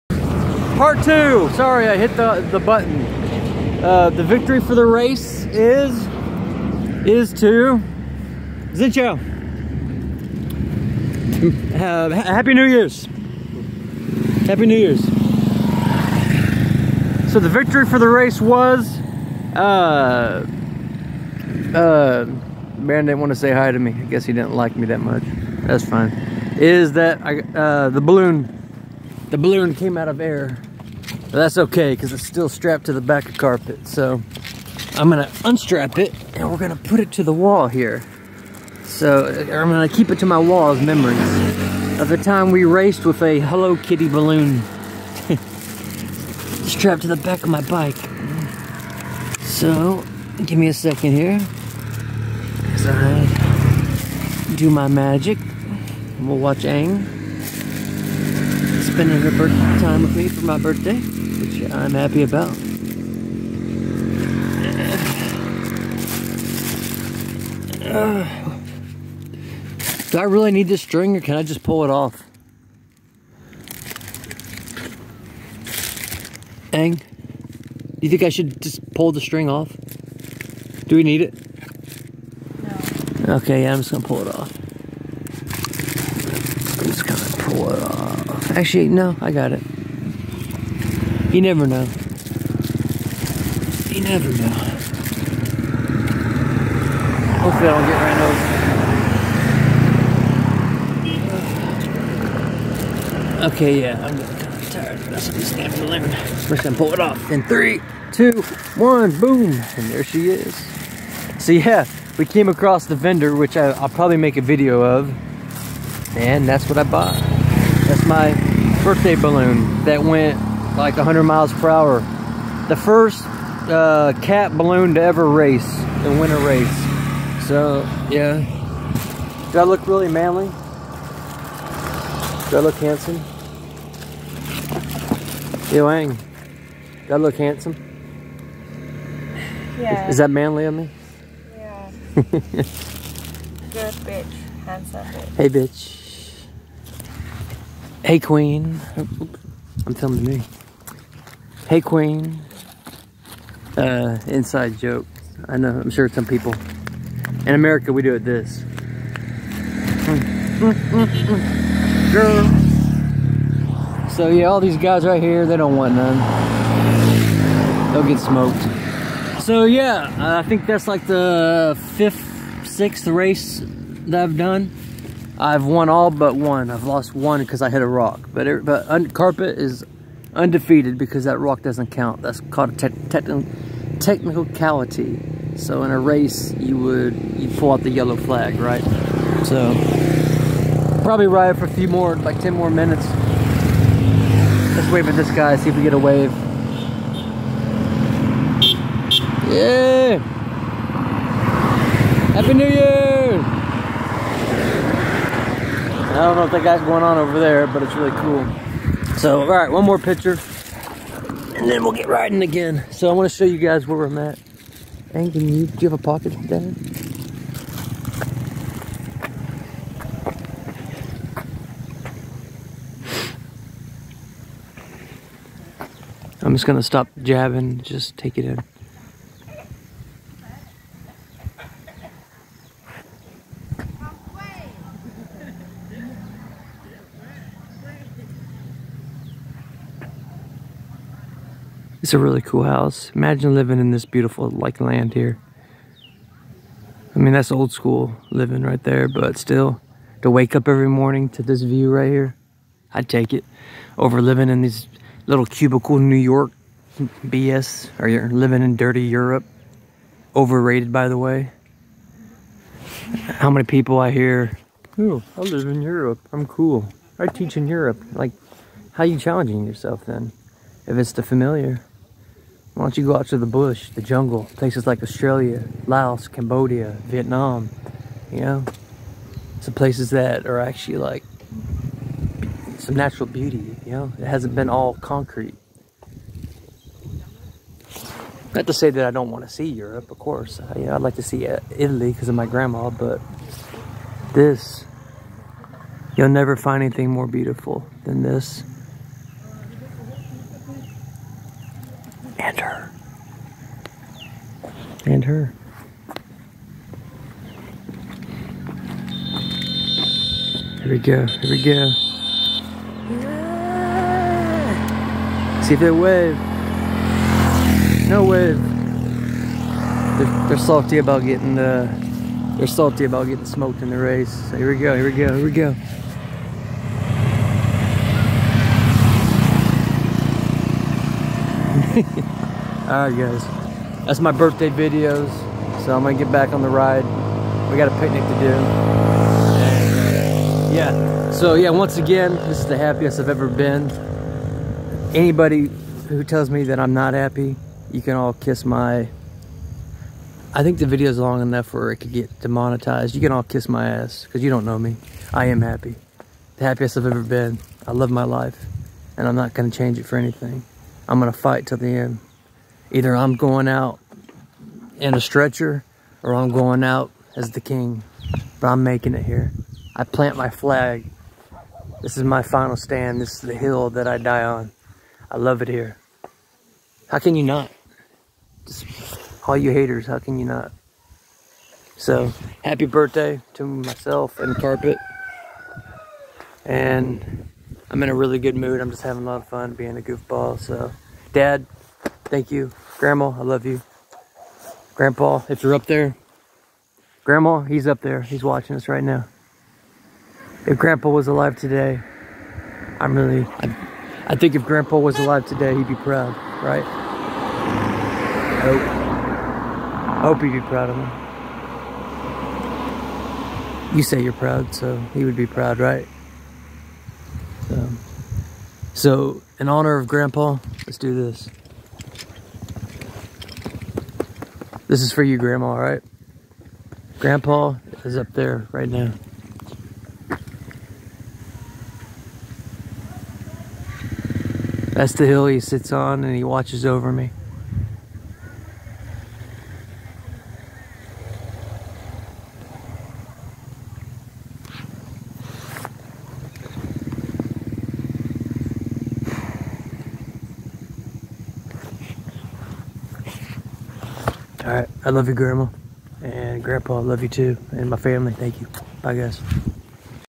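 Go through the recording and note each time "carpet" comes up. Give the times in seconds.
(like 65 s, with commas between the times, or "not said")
33 s, 179 s, 384 s.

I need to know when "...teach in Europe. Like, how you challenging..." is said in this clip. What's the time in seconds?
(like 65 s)
267 s.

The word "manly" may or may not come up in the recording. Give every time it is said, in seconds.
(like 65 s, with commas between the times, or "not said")
130 s, 140 s.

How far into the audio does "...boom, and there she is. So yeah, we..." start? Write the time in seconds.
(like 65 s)
109 s.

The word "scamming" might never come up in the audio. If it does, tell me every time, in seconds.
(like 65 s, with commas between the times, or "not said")
105 s.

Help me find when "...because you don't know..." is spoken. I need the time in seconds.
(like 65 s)
354 s.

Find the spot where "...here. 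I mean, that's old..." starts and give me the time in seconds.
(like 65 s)
245 s.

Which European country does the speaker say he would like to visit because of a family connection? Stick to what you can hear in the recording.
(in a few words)
Italy.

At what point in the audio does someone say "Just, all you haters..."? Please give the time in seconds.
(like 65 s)
378 s.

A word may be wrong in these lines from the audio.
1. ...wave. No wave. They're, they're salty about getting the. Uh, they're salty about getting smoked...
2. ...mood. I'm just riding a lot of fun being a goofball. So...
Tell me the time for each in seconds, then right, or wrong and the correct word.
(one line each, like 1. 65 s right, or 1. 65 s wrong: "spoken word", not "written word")
1. 315 s right
2. 388 s wrong: "having", not "riding".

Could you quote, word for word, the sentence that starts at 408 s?
I hope, I hope he'd be proud of me.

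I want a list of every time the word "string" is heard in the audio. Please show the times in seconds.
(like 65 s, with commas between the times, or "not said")
70 s, 79 s.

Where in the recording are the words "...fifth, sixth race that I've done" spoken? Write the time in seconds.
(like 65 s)
171 s.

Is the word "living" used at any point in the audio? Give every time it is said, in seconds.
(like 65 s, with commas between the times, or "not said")
243 s, 248 s, 254 s, 258 s.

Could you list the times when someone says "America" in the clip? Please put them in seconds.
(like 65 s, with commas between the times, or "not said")
157 s.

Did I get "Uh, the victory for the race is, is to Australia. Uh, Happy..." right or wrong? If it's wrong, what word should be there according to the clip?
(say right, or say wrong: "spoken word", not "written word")
wrong: "Zincho", not "Australia".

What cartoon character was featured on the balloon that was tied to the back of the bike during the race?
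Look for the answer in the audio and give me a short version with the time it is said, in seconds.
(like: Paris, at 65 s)
Hello Kitty, at 43 s.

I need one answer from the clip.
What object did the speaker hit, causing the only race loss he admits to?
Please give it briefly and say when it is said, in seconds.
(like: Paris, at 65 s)
A rock, at 177 s.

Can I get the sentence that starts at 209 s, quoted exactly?
So, all right, one more picture and then we'll get riding again.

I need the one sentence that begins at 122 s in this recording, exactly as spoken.
The first uh, cat balloon to ever race and win a race.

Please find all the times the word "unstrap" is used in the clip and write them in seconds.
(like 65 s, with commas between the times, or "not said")
35 s.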